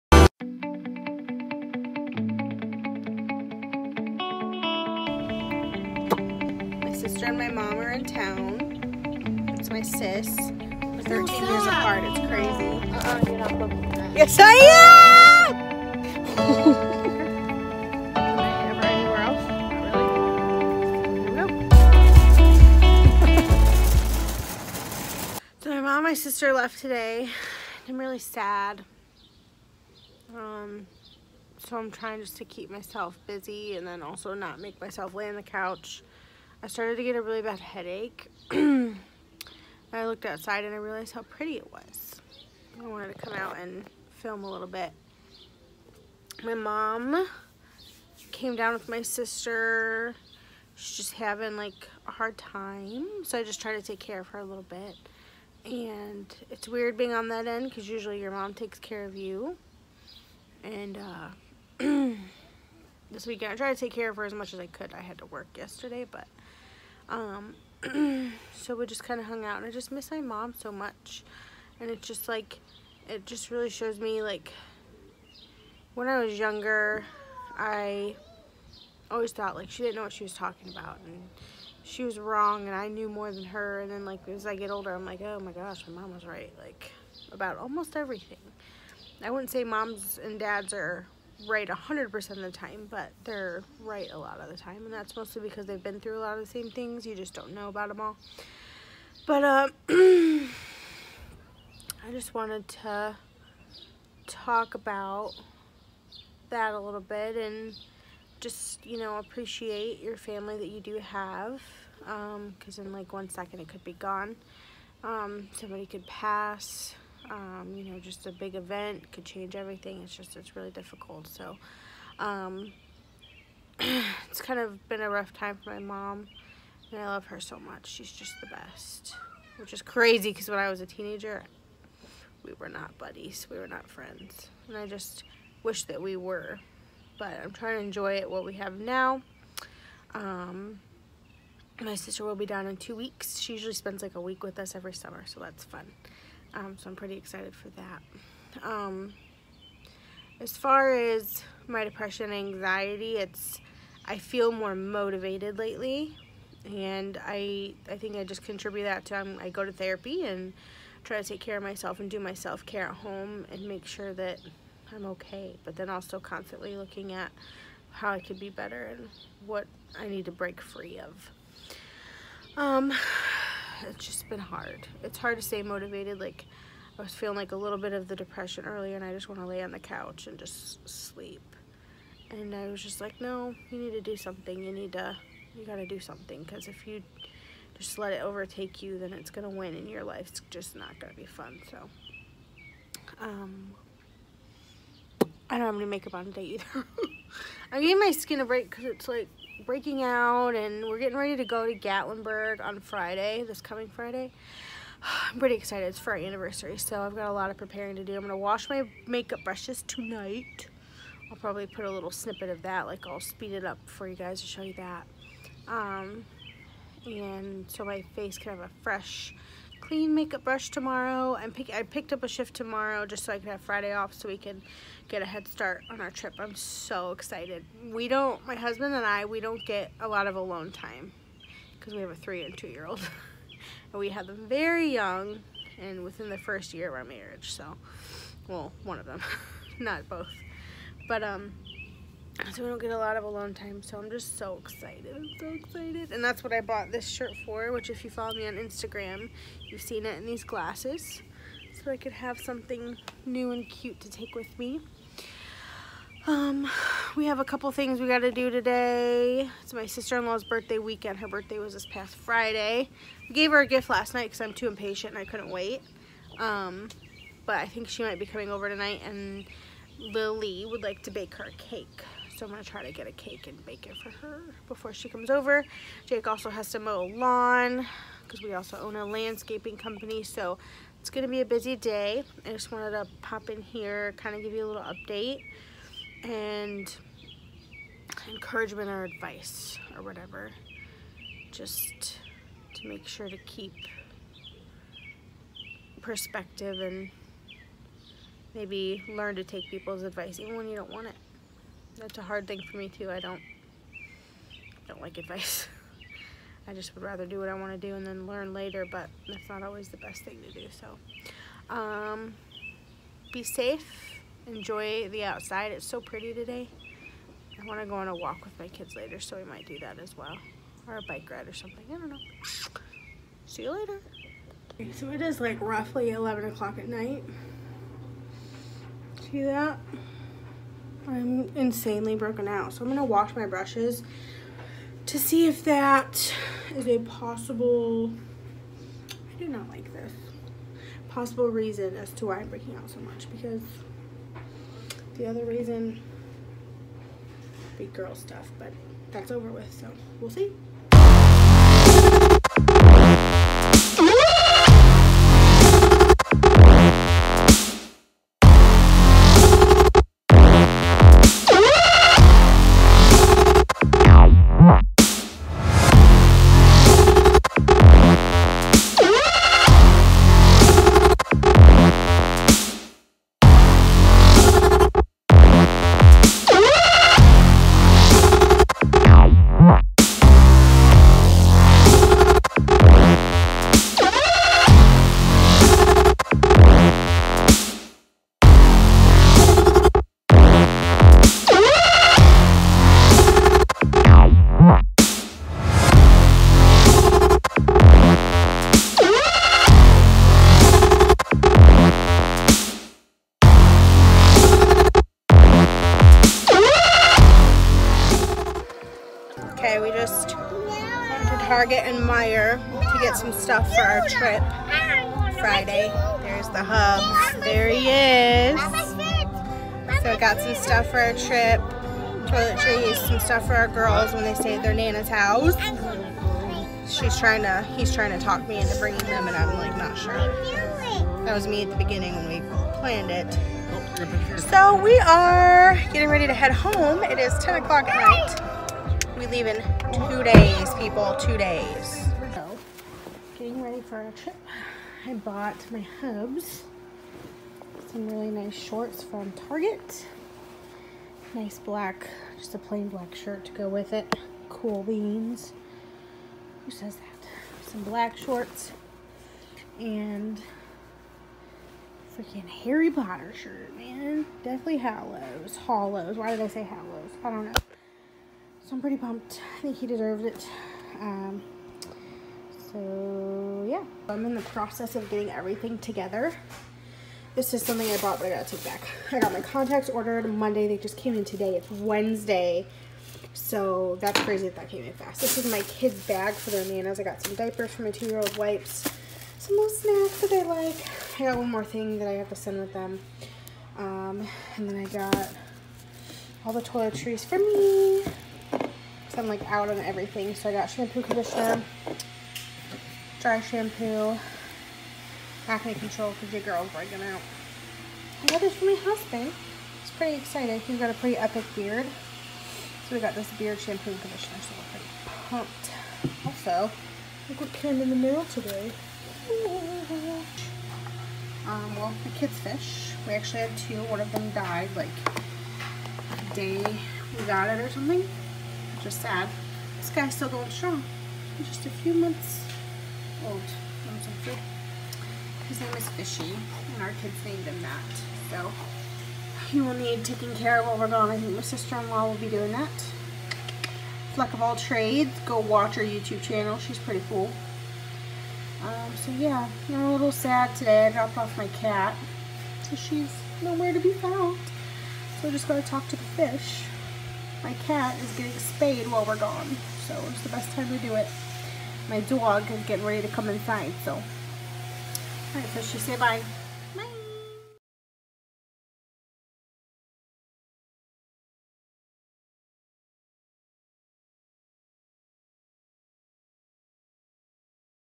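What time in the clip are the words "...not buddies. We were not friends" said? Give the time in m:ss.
2:12.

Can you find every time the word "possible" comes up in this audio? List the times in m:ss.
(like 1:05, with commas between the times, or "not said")
5:36, 5:41.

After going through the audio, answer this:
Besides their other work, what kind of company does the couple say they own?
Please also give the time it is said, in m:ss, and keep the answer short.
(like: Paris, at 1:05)
Landscaping company, at 4:39.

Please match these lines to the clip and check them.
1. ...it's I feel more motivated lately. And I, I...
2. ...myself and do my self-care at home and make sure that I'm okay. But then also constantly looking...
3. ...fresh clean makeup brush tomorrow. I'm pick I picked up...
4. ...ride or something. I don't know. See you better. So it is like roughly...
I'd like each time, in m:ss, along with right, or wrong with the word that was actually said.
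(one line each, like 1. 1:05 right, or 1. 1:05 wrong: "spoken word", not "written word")
1. 2:33 right
2. 2:41 right
3. 3:38 right
4. 5:21 wrong: "later", not "better".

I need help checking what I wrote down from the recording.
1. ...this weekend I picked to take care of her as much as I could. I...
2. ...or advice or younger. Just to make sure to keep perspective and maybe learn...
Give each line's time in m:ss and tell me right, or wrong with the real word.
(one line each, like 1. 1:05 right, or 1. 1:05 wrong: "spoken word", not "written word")
1. 1:03 wrong: "tried", not "picked"
2. 4:48 wrong: "whatever", not "younger".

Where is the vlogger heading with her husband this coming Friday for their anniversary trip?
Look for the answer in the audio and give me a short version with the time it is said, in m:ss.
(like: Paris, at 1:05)
Gatlinburg, at 3:21.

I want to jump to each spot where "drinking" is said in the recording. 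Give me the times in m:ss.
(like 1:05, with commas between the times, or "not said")
not said.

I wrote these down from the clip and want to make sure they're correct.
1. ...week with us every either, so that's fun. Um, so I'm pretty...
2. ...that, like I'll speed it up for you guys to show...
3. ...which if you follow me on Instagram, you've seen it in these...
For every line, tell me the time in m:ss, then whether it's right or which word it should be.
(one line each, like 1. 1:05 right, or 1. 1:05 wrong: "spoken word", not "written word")
1. 2:24 wrong: "summer", not "either"
2. 3:32 right
3. 4:07 right.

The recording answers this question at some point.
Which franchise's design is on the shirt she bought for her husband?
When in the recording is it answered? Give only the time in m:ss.
7:42.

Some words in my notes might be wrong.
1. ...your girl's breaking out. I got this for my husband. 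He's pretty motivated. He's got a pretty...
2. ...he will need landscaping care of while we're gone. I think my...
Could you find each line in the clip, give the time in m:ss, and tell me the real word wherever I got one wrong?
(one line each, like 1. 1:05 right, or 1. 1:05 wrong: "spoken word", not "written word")
1. 8:26 wrong: "excited", not "motivated"
2. 8:59 wrong: "taking", not "landscaping".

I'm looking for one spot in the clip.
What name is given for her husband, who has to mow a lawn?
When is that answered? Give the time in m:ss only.
4:36.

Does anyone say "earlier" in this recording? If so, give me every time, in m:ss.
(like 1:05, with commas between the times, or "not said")
2:58.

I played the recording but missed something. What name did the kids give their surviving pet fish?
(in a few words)
Fishy.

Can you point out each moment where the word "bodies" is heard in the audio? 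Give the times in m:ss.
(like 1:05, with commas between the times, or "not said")
not said.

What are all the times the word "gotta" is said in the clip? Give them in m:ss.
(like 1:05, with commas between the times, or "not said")
7:58, 9:15.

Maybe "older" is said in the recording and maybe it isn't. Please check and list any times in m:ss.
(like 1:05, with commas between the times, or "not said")
1:24.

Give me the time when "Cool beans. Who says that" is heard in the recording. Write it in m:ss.
7:34.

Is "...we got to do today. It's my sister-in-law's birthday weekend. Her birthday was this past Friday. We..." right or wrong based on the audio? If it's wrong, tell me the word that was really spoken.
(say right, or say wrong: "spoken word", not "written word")
right.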